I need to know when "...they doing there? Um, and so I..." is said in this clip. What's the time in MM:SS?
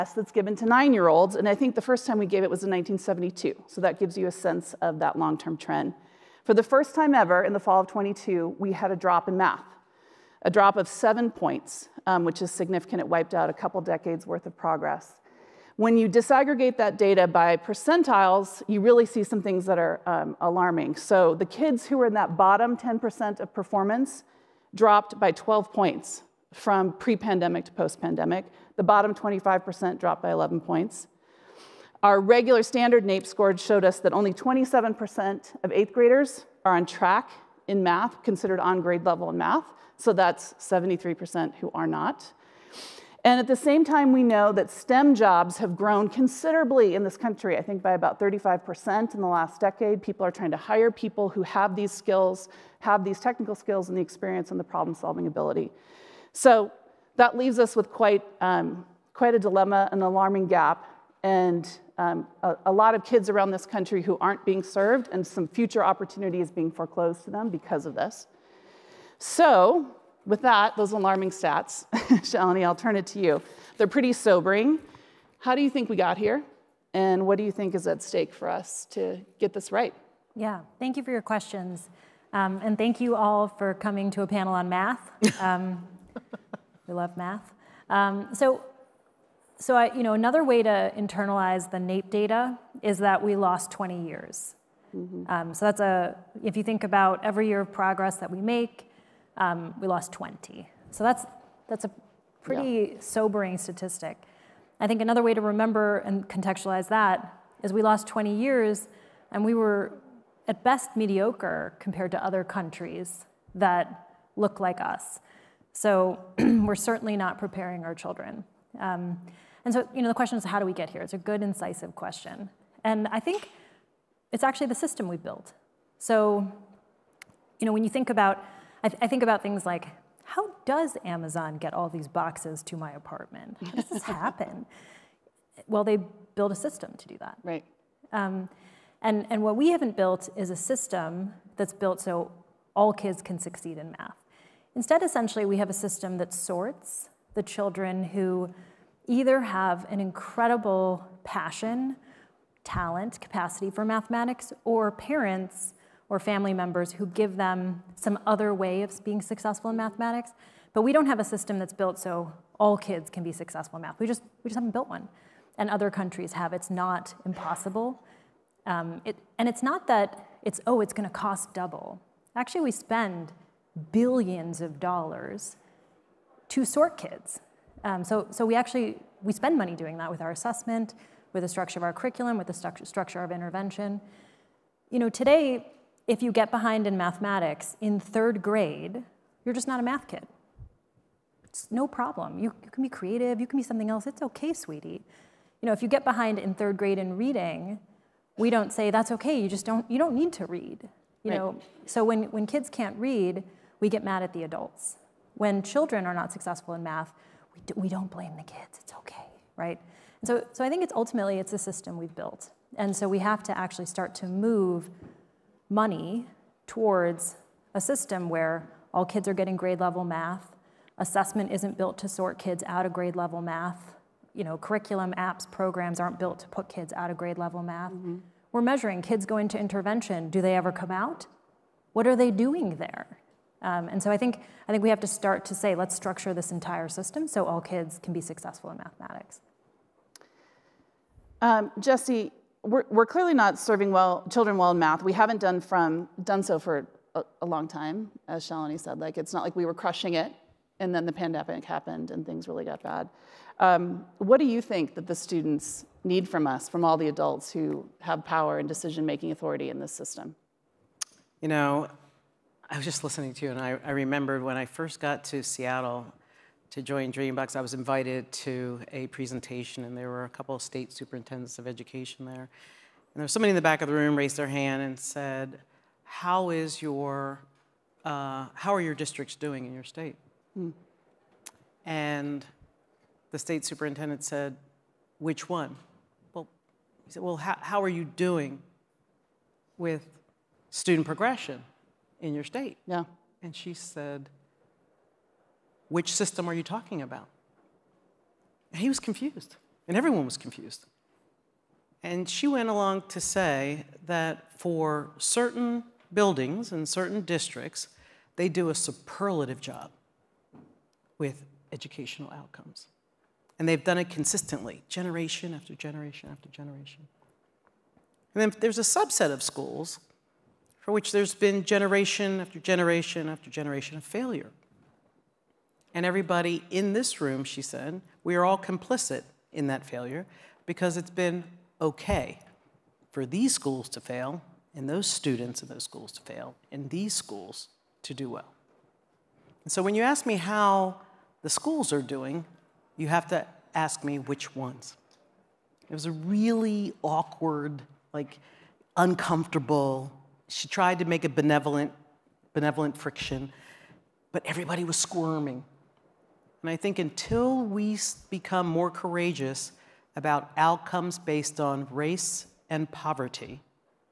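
03:52.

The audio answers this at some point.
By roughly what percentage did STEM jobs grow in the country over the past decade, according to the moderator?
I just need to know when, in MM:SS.
00:48.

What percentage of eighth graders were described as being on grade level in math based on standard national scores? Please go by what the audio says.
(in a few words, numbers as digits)
27%.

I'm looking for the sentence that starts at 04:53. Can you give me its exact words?
And she said, Which system are you talking about?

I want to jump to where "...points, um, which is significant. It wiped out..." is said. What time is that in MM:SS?
00:11.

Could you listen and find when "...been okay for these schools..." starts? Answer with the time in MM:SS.
05:31.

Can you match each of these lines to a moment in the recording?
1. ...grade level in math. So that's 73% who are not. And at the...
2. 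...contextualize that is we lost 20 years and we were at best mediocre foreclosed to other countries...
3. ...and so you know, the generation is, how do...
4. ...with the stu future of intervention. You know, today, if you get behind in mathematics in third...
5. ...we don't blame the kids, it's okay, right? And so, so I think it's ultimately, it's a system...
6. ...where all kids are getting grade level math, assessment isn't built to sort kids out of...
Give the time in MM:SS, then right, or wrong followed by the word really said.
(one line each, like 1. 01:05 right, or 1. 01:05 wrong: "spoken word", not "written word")
1. 00:38 right
2. 01:46 wrong: "compared", not "foreclosed"
3. 01:59 wrong: "question", not "generation"
4. 03:02 wrong: "structure", not "future"
5. 03:27 right
6. 03:38 right.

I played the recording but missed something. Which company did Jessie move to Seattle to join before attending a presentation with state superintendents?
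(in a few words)
Dreambox.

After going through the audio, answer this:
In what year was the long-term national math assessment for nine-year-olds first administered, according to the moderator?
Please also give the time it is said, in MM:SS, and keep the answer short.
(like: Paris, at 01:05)
1972, at 00:02.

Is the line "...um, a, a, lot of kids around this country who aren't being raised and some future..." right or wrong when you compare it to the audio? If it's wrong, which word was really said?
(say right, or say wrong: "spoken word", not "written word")
wrong: "served", not "raised".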